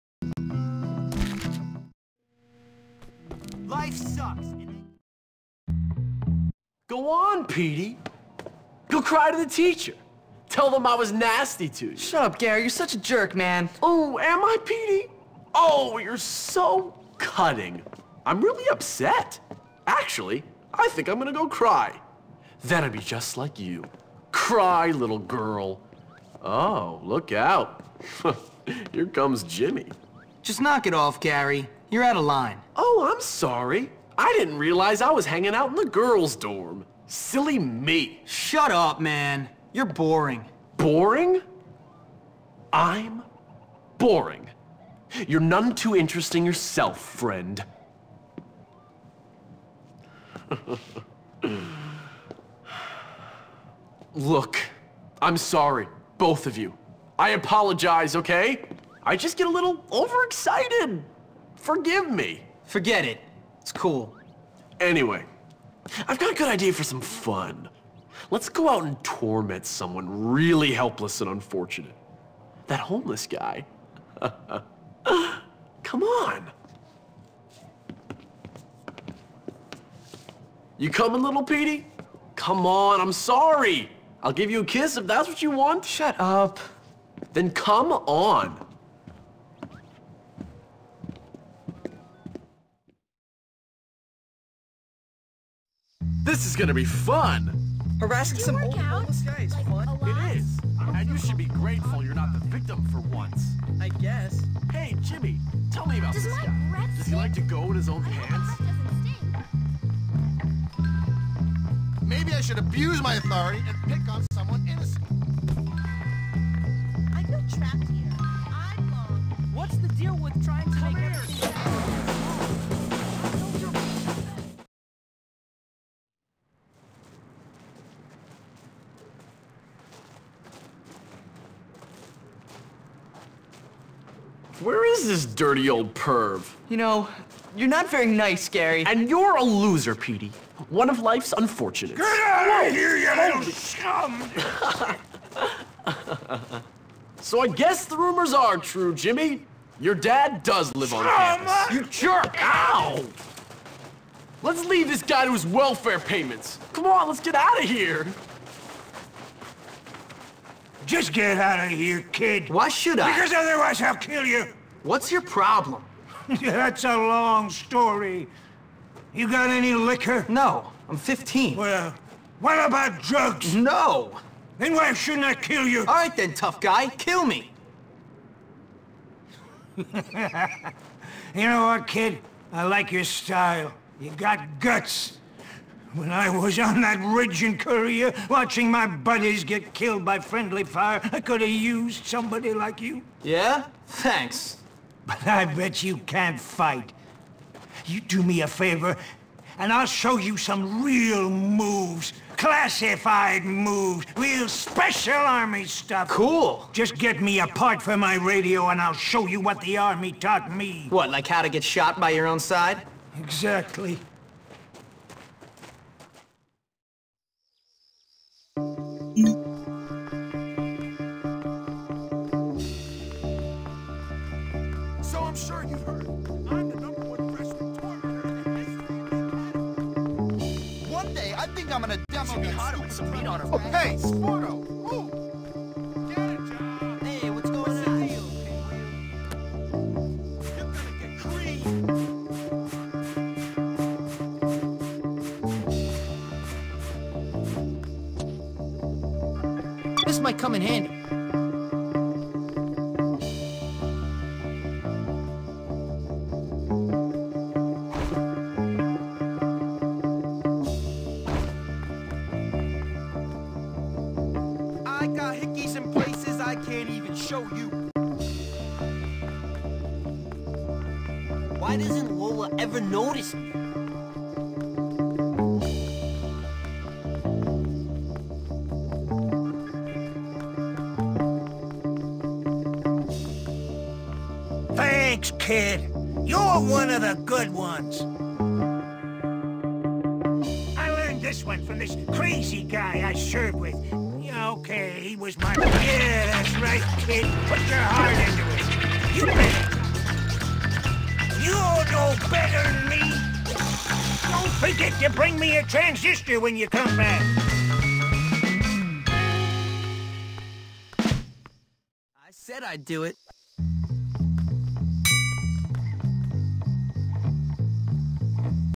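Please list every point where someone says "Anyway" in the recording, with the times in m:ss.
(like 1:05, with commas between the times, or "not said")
1:04.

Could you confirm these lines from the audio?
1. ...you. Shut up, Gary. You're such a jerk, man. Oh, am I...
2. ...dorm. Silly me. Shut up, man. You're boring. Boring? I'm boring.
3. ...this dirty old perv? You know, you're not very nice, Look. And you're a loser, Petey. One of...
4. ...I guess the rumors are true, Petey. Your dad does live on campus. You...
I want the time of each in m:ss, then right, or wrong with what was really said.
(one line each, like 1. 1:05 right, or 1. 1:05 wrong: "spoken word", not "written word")
1. 0:11 right
2. 0:36 right
3. 2:15 wrong: "Gary", not "Look"
4. 2:27 wrong: "Jimmy", not "Petey".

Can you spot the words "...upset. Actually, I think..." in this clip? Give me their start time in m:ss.
0:18.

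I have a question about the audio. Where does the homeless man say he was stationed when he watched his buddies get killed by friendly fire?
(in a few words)
Korea.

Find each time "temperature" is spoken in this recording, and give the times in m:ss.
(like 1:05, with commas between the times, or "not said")
not said.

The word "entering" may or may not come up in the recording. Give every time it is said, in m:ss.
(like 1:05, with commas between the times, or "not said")
not said.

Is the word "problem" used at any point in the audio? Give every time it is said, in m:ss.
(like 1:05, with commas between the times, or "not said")
2:45.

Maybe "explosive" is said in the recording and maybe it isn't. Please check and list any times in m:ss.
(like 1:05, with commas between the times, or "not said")
not said.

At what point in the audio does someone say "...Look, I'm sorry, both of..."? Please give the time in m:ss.
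0:54.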